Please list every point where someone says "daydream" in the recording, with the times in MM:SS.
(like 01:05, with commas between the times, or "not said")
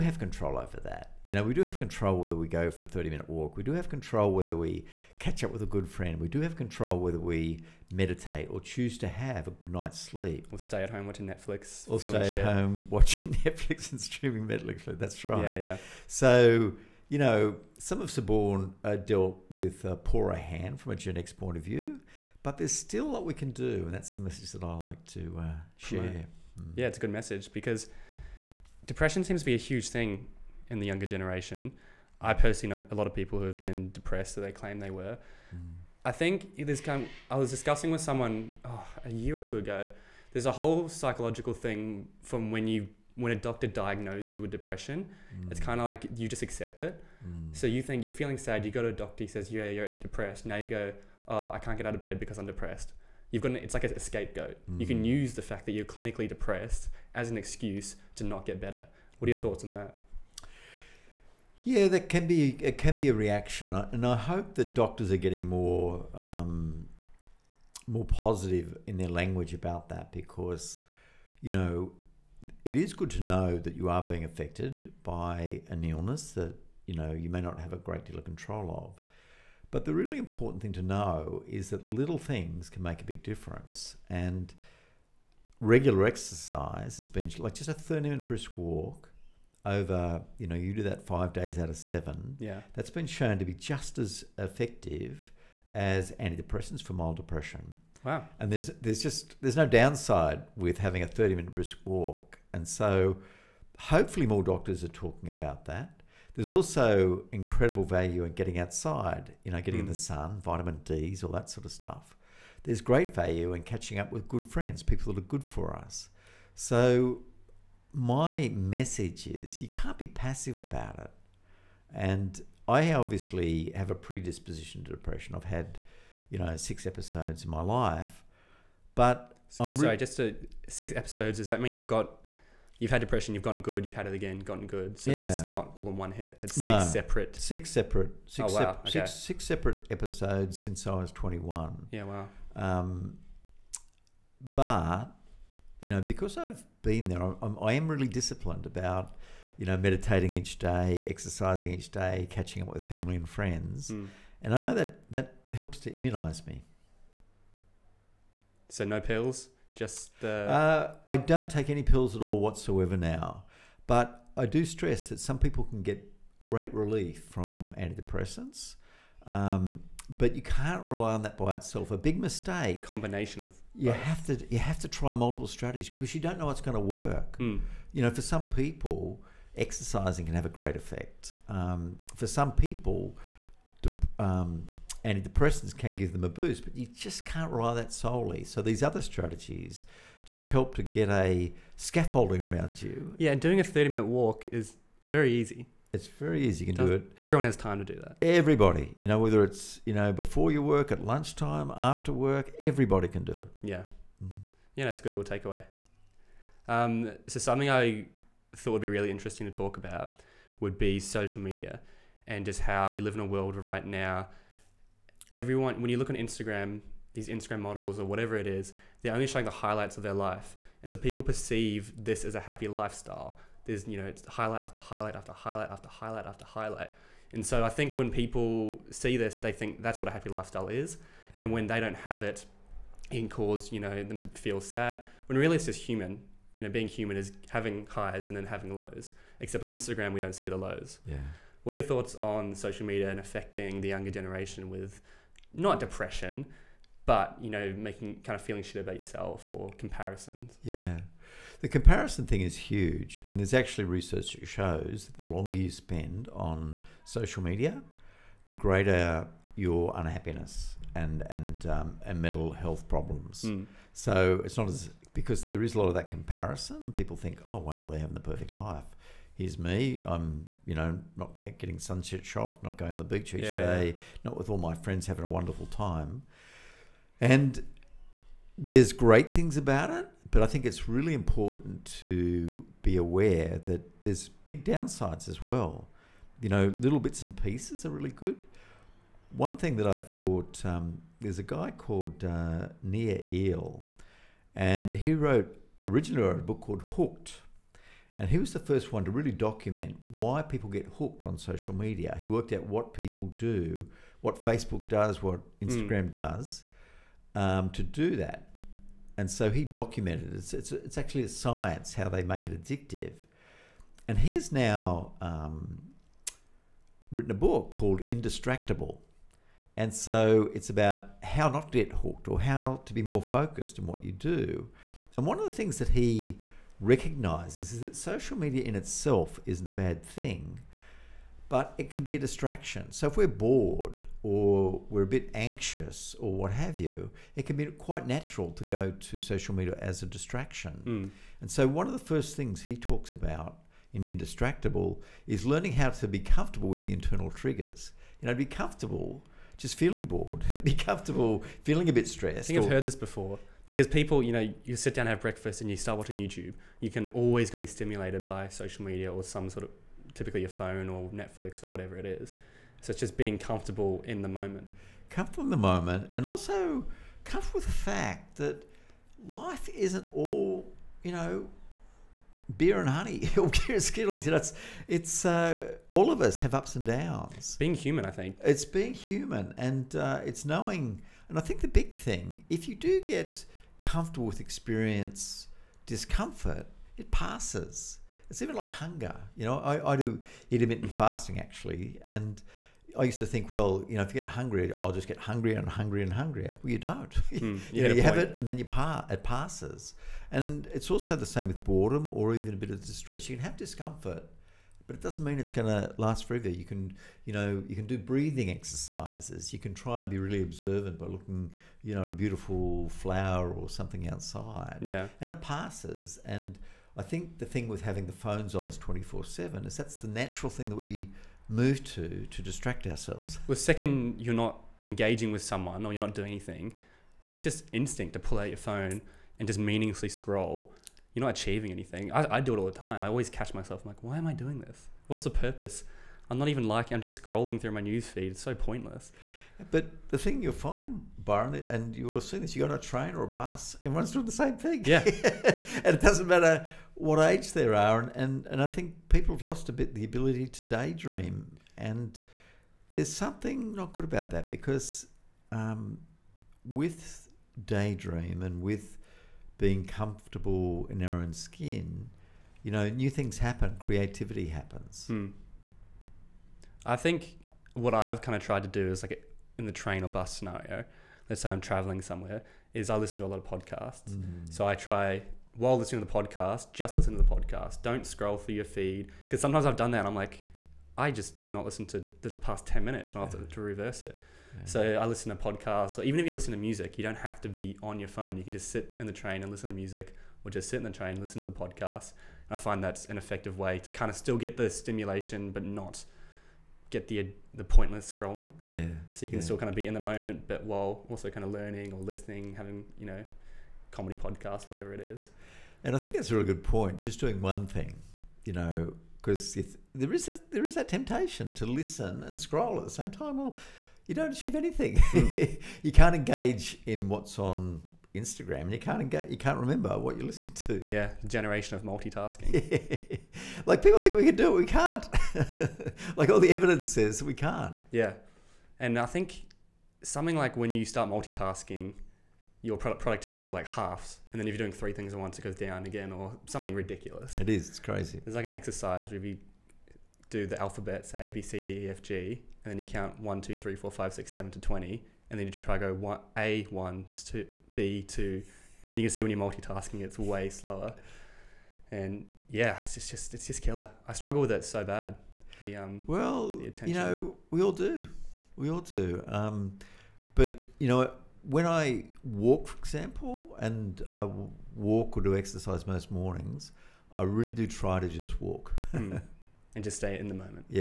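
07:30, 07:37.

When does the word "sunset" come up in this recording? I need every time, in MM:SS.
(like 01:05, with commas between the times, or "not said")
04:31.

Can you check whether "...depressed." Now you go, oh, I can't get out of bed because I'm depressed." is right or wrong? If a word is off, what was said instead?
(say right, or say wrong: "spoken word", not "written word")
right.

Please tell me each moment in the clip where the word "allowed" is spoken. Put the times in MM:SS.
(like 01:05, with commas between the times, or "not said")
not said.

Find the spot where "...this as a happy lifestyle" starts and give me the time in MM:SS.
03:41.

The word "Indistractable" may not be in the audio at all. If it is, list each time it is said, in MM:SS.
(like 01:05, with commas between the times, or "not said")
05:18, 05:44.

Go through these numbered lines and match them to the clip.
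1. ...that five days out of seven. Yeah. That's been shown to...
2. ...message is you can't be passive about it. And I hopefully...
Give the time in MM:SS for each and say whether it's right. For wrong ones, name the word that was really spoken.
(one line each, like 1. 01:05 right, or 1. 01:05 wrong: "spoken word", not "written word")
1. 01:30 right
2. 01:58 wrong: "obviously", not "hopefully".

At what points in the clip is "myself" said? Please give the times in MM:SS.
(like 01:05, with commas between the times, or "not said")
07:13.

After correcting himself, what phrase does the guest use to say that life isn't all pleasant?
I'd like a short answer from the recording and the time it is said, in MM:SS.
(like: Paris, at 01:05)
beer and Skittles, at 06:13.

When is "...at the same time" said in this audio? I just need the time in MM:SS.
08:32.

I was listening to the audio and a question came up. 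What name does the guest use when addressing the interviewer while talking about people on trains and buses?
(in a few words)
Byron.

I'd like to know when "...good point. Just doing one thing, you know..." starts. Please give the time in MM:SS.
08:26.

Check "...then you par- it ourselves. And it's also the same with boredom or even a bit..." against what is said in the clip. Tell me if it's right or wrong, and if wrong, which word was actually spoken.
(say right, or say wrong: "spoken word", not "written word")
wrong: "passes", not "ourselves".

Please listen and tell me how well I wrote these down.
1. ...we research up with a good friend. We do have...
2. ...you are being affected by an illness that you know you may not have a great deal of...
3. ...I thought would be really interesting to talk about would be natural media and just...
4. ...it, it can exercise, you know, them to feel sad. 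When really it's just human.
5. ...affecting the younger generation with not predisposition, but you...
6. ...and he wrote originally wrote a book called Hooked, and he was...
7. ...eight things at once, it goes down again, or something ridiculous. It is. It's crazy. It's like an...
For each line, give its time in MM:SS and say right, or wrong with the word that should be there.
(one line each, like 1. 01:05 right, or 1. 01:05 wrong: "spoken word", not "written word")
1. 00:04 wrong: "catch", not "research"
2. 01:13 right
3. 03:27 wrong: "social", not "natural"
4. 03:52 wrong: "cause", not "exercise"
5. 04:03 wrong: "depression", not "predisposition"
6. 04:54 right
7. 08:54 wrong: "three", not "eight".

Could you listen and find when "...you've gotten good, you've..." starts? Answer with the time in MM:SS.
02:13.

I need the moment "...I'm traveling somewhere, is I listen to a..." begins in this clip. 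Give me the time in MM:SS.
07:51.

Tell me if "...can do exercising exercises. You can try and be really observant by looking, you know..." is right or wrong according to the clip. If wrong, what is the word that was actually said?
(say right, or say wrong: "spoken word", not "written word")
wrong: "breathing", not "exercising".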